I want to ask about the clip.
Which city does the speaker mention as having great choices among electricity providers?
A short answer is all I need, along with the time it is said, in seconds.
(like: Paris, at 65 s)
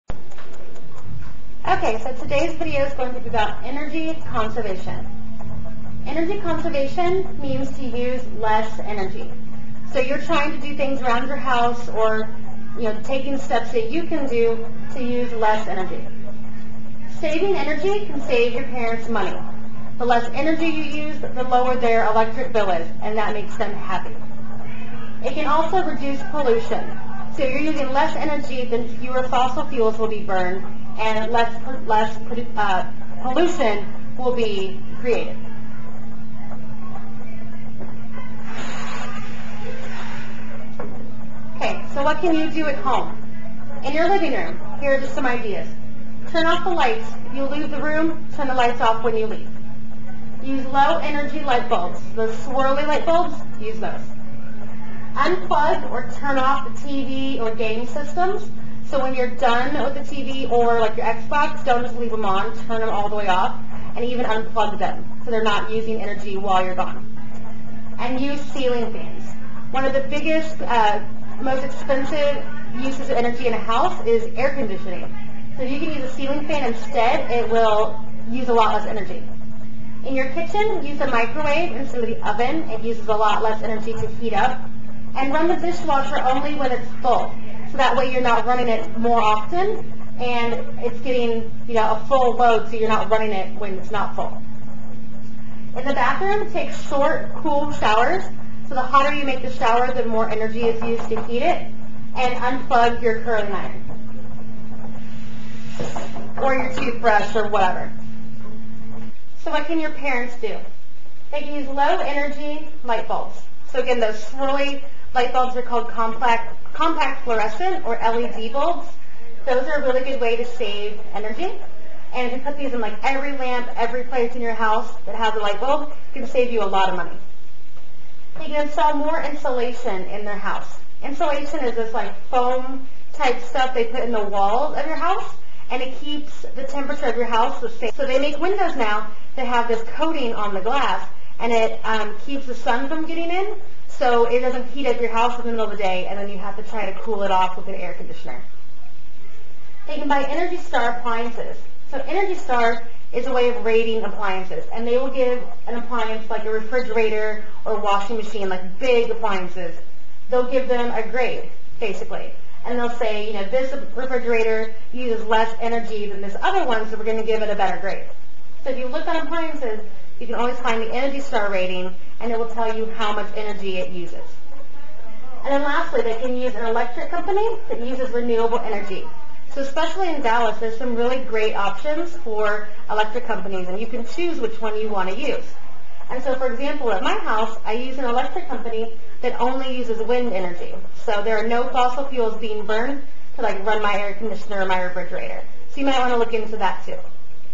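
Dallas, at 180 s.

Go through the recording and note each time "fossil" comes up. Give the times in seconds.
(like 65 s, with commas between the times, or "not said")
29 s, 191 s.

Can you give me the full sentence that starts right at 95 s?
In the bathroom, take short, cool showers.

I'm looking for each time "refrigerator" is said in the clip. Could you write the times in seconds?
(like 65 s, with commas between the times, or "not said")
156 s, 163 s, 194 s.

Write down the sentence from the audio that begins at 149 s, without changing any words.
They can buy Energy Star appliances.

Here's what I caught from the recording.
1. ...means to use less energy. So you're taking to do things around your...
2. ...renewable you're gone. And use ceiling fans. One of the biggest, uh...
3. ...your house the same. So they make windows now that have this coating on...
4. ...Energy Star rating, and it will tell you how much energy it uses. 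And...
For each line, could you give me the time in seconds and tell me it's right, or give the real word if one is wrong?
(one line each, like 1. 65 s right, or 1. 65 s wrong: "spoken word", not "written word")
1. 7 s wrong: "trying", not "taking"
2. 66 s wrong: "while", not "renewable"
3. 137 s right
4. 170 s right.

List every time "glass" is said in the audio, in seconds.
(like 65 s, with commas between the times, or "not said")
140 s.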